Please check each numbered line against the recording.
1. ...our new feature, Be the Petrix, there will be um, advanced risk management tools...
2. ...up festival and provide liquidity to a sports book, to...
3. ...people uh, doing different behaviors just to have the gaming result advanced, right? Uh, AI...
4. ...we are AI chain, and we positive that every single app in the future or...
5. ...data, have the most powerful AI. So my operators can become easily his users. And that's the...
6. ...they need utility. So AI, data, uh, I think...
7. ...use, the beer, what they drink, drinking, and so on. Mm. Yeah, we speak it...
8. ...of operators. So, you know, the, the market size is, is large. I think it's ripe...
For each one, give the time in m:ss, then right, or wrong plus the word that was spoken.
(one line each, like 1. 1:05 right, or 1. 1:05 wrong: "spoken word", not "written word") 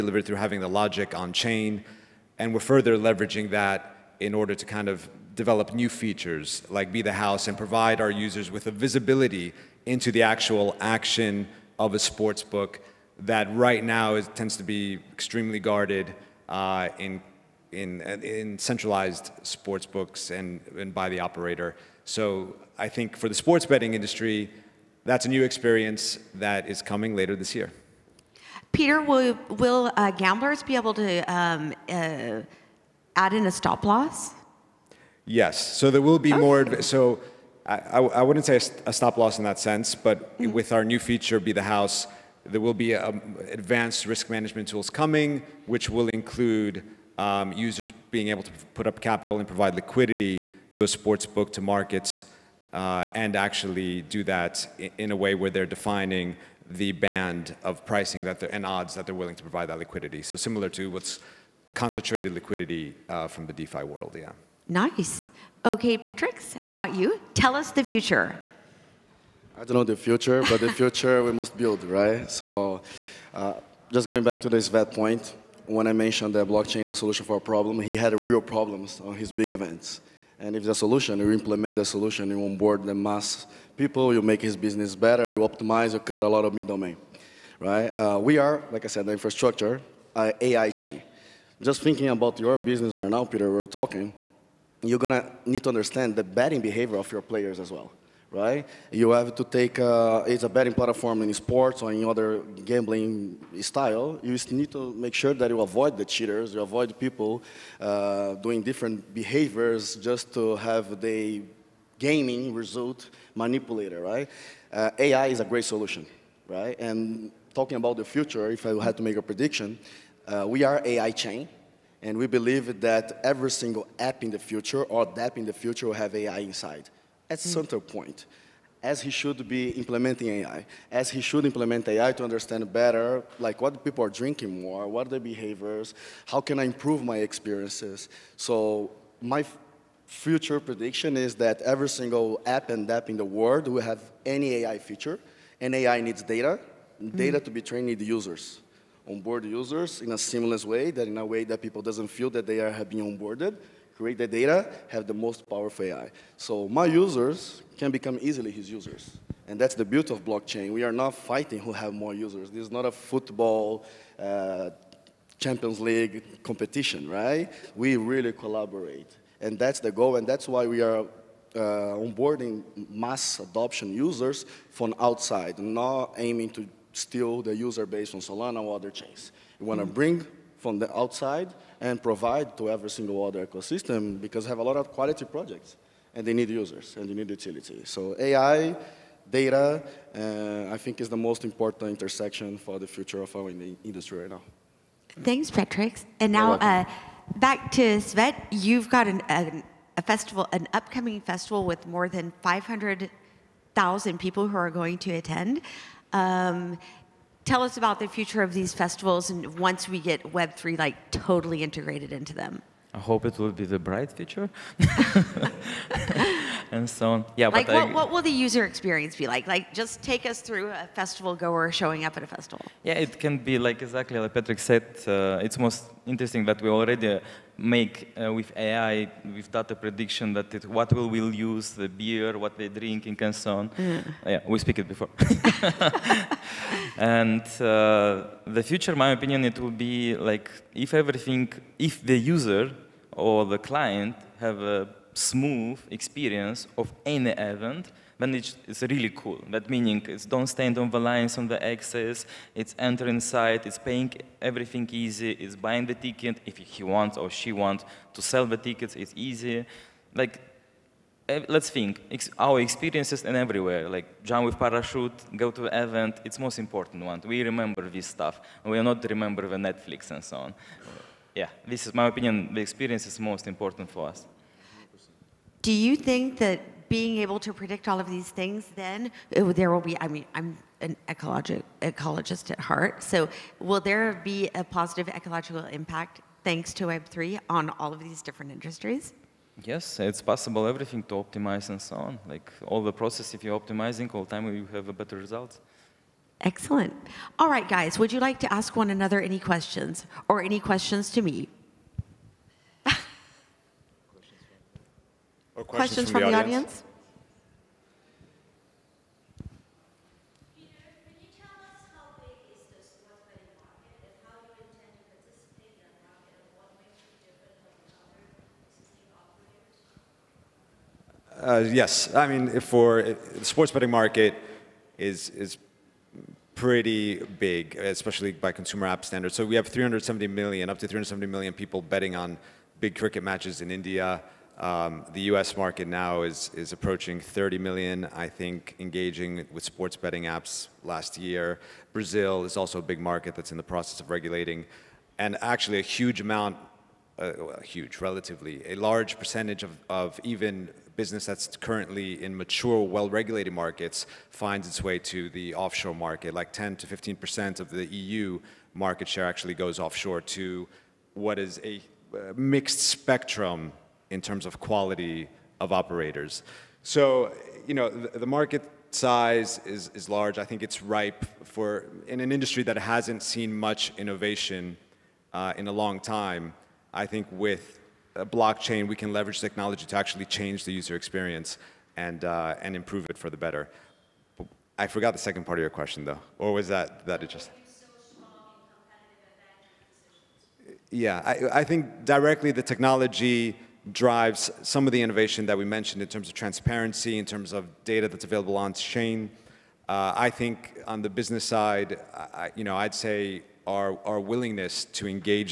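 1. 0:40 wrong: "House", not "Petrix"
2. 0:48 wrong: "capital", not "festival"
3. 1:46 wrong: "manipulated", not "advanced"
4. 2:00 wrong: "believe", not "positive"
5. 2:34 wrong: "users", not "operators"
6. 3:07 right
7. 3:51 right
8. 6:05 right.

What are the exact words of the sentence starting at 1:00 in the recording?
So similar to what's concentrated liquidity uh, from the DeFi world, yeah.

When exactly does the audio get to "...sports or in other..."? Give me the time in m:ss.
1:41.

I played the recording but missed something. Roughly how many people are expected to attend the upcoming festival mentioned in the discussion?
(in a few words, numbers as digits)
500,000.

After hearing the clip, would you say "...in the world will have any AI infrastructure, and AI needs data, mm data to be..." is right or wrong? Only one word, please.
wrong.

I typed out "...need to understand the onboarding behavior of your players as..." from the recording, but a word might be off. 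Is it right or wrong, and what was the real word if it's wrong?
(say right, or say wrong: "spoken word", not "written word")
wrong: "betting", not "onboarding".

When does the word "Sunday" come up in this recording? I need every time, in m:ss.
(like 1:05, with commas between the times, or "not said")
not said.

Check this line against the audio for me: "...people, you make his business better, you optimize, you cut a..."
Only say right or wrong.
right.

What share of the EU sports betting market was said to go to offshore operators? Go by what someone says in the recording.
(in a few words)
10 to 15 percent.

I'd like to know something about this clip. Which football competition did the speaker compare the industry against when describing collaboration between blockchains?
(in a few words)
Champions League.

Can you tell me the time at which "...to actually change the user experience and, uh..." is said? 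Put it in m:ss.
6:19.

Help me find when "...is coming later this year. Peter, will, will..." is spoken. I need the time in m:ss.
0:26.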